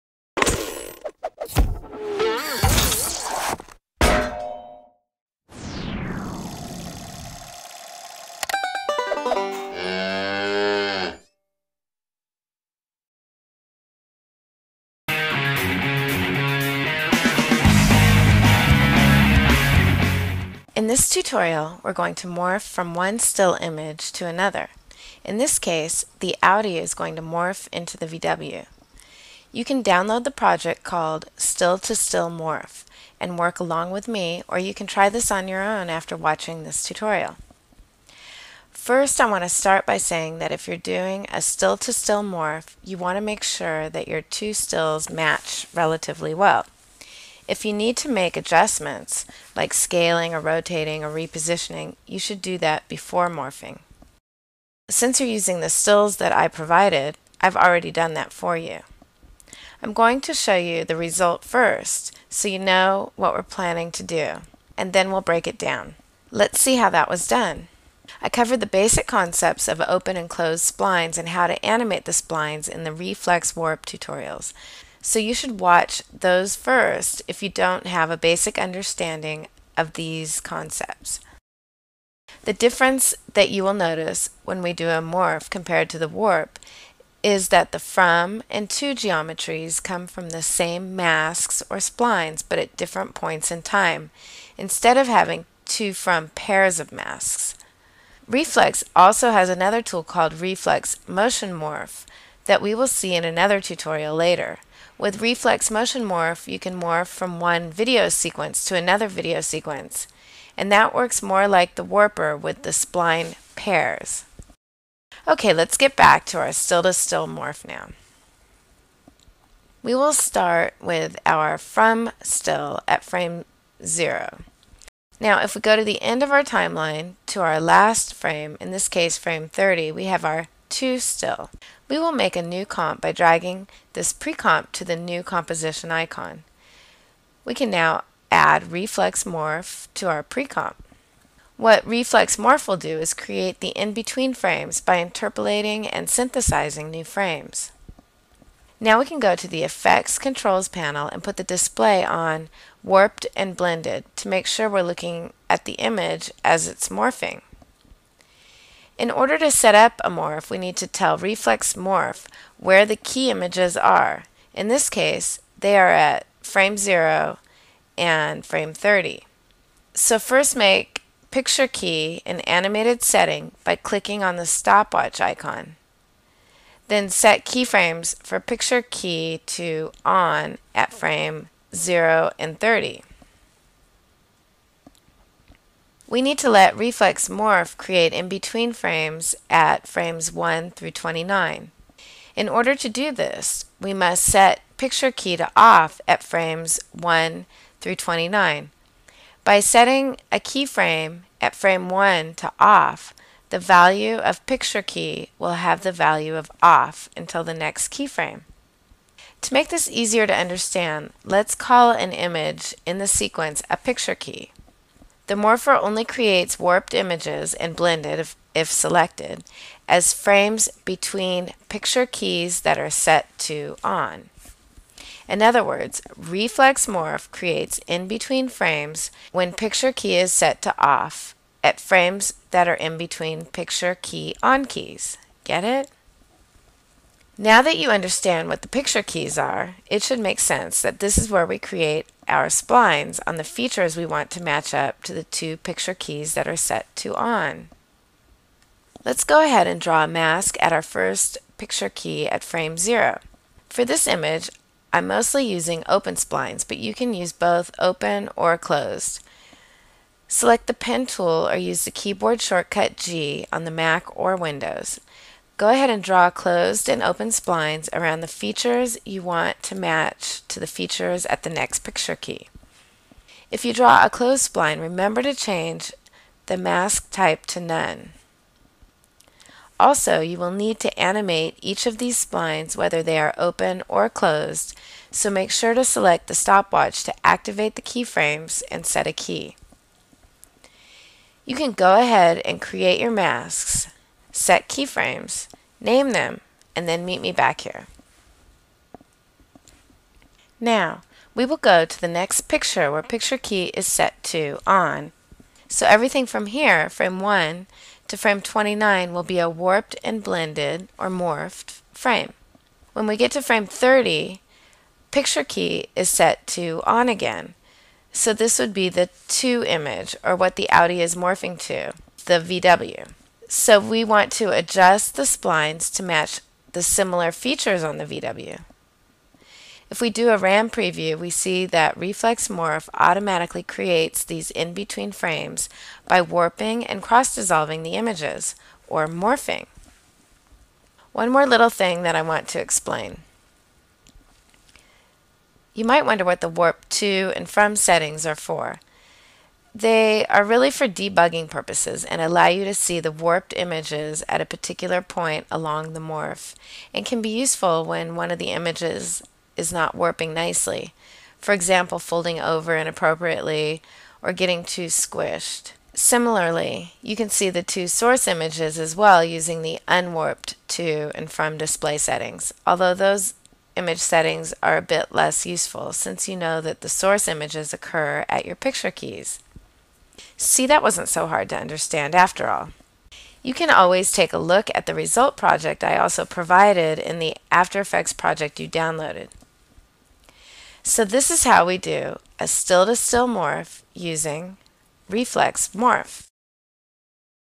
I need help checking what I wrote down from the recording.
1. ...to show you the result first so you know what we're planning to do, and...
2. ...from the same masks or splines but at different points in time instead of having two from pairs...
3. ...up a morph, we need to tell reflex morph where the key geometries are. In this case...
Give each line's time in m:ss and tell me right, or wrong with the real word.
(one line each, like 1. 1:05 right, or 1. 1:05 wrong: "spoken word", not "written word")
1. 1:00 right
2. 1:30 right
3. 2:39 wrong: "images", not "geometries".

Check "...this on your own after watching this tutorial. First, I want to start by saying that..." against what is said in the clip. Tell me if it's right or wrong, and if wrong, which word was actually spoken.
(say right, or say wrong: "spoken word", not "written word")
right.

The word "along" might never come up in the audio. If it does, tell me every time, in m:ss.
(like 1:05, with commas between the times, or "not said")
0:33, 5:55.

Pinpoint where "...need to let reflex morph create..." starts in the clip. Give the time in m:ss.
3:06.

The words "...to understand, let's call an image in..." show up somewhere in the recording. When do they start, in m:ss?
3:30.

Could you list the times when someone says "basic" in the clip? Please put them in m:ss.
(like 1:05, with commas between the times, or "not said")
1:08, 1:18.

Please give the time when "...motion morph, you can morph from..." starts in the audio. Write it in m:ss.
1:45.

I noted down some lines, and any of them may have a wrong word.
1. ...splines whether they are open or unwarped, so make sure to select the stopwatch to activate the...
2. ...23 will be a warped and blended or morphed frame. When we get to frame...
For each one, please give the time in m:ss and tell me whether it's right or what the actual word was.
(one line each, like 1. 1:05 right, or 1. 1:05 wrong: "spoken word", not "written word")
1. 4:42 wrong: "closed", not "unwarped"
2. 5:08 wrong: "29", not "23".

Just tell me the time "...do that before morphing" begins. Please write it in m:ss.
0:52.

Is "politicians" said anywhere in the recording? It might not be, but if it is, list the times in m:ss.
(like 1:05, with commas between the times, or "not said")
not said.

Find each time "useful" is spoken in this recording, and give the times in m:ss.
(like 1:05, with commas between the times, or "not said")
5:57, 6:15.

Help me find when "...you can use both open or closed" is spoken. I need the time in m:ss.
4:16.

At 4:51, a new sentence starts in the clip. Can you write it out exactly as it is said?
You can go ahead and create your masks set keyframes, name them, and then meet me back here.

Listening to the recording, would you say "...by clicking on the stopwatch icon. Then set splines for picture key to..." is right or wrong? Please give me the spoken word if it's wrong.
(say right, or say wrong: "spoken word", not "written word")
wrong: "keyframes", not "splines".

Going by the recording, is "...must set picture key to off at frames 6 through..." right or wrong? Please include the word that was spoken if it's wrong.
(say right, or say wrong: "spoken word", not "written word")
wrong: "1", not "6".